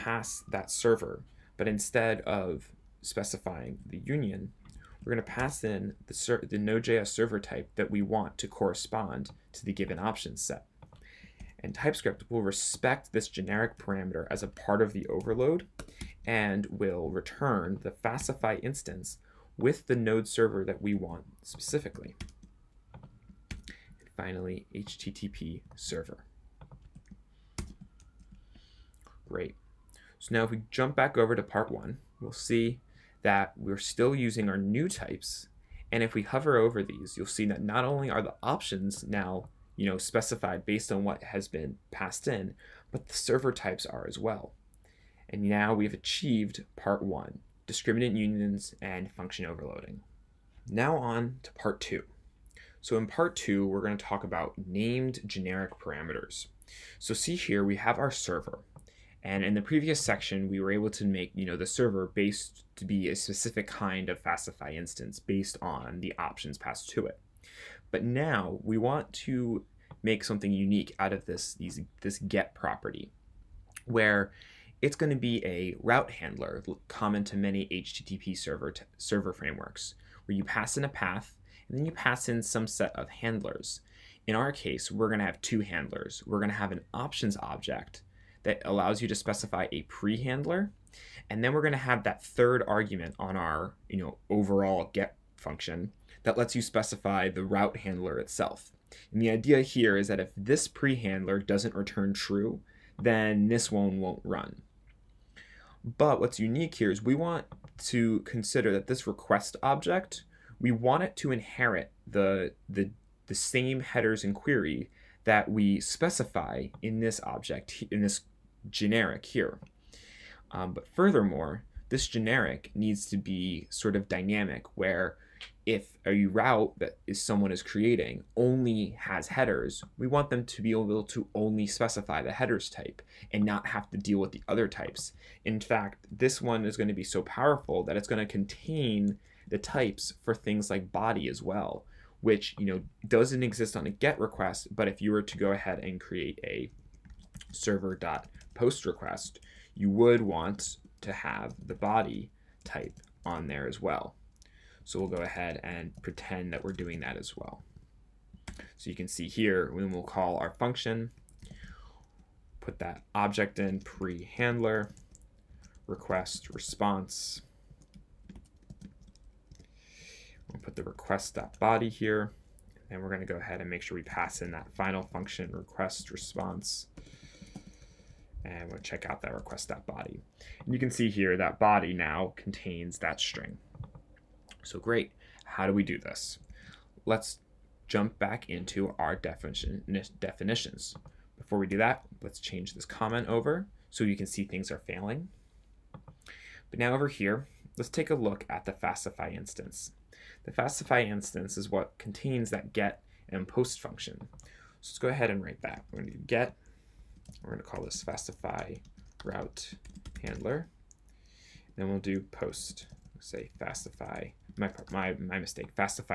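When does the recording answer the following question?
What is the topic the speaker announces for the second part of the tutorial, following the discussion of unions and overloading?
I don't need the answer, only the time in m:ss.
0:54.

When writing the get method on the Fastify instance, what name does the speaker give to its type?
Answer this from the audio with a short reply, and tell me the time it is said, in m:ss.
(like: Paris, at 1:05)
Fastify route handler, at 3:28.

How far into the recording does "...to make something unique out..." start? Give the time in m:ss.
1:09.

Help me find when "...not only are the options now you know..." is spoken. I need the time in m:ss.
0:37.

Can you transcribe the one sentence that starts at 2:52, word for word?
And we're going to go ahead and make sure we pass in that final function request response.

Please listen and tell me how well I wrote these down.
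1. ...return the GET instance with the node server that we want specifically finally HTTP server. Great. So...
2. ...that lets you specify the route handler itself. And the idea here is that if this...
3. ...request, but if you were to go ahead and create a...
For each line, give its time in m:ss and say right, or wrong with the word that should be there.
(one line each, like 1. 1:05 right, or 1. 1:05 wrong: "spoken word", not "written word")
1. 0:17 wrong: "Fastify", not "GET"
2. 1:36 right
3. 2:24 right.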